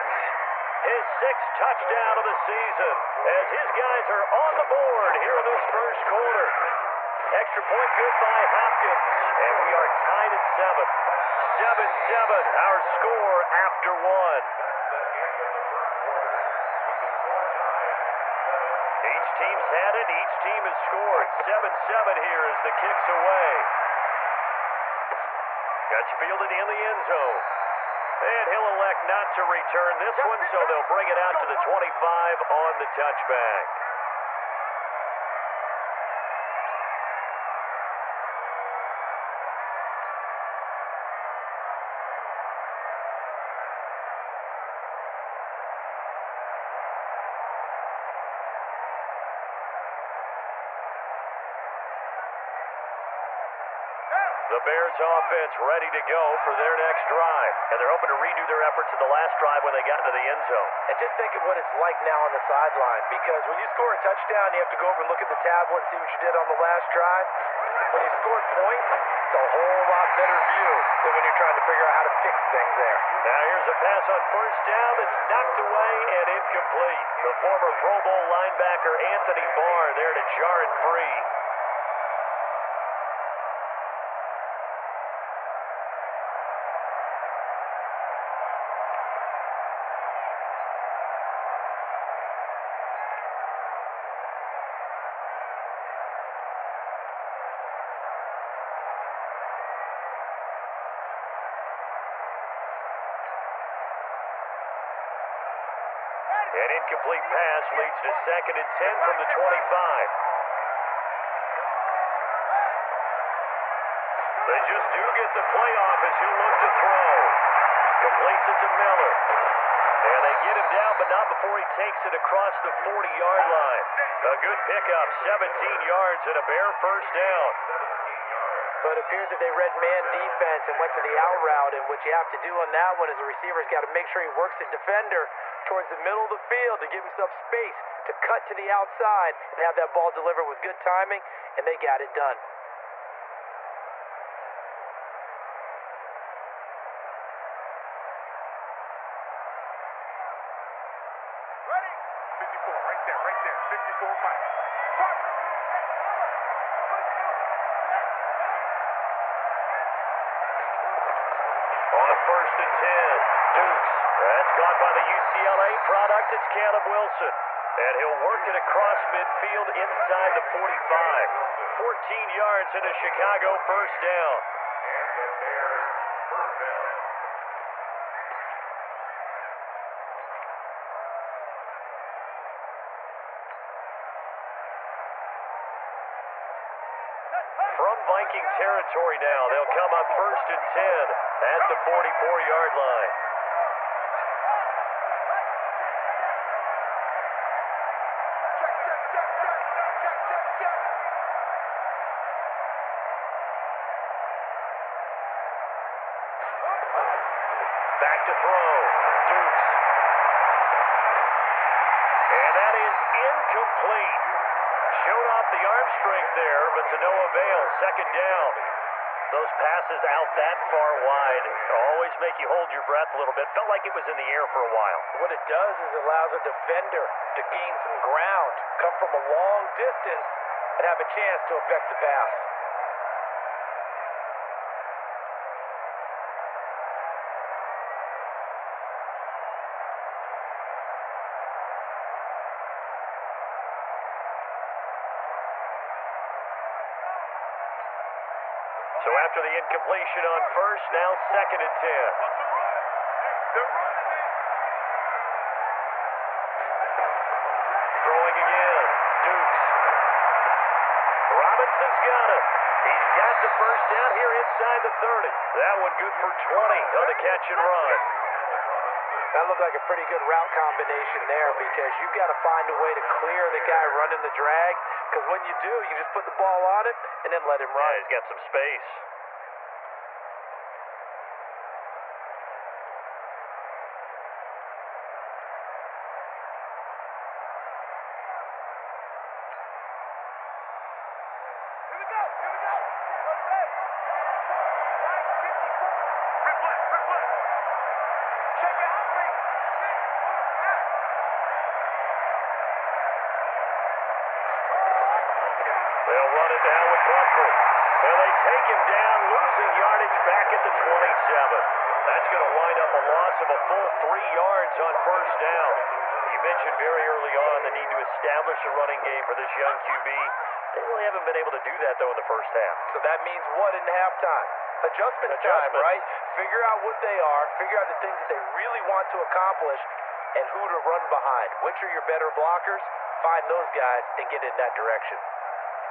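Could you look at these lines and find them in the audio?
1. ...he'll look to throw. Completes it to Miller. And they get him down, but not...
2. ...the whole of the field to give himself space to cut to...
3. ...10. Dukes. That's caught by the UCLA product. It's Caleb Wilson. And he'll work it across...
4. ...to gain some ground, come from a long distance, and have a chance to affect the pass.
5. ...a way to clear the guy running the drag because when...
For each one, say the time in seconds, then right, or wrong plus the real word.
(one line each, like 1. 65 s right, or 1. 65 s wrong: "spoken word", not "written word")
1. 116 s right
2. 135 s wrong: "middle", not "whole"
3. 162 s right
4. 227 s right
5. 272 s right.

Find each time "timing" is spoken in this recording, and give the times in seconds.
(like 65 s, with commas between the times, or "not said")
140 s.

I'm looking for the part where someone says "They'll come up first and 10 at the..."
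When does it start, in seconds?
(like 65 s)
189 s.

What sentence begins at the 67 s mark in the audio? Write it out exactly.
When you scored points, it's a whole lot better view than when you're trying to figure out how to fix things there.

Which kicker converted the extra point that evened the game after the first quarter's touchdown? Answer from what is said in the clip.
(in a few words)
Hopkins.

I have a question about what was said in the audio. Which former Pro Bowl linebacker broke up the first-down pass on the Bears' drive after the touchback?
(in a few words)
Anthony Barr.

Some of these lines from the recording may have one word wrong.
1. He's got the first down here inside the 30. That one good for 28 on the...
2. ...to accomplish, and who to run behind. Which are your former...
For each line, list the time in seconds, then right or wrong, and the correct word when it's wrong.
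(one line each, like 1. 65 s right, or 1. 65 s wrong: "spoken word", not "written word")
1. 262 s wrong: "20", not "28"
2. 329 s wrong: "better", not "former".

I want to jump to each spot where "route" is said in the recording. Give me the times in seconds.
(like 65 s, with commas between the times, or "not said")
131 s, 270 s.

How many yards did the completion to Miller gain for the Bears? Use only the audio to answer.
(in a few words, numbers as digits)
17.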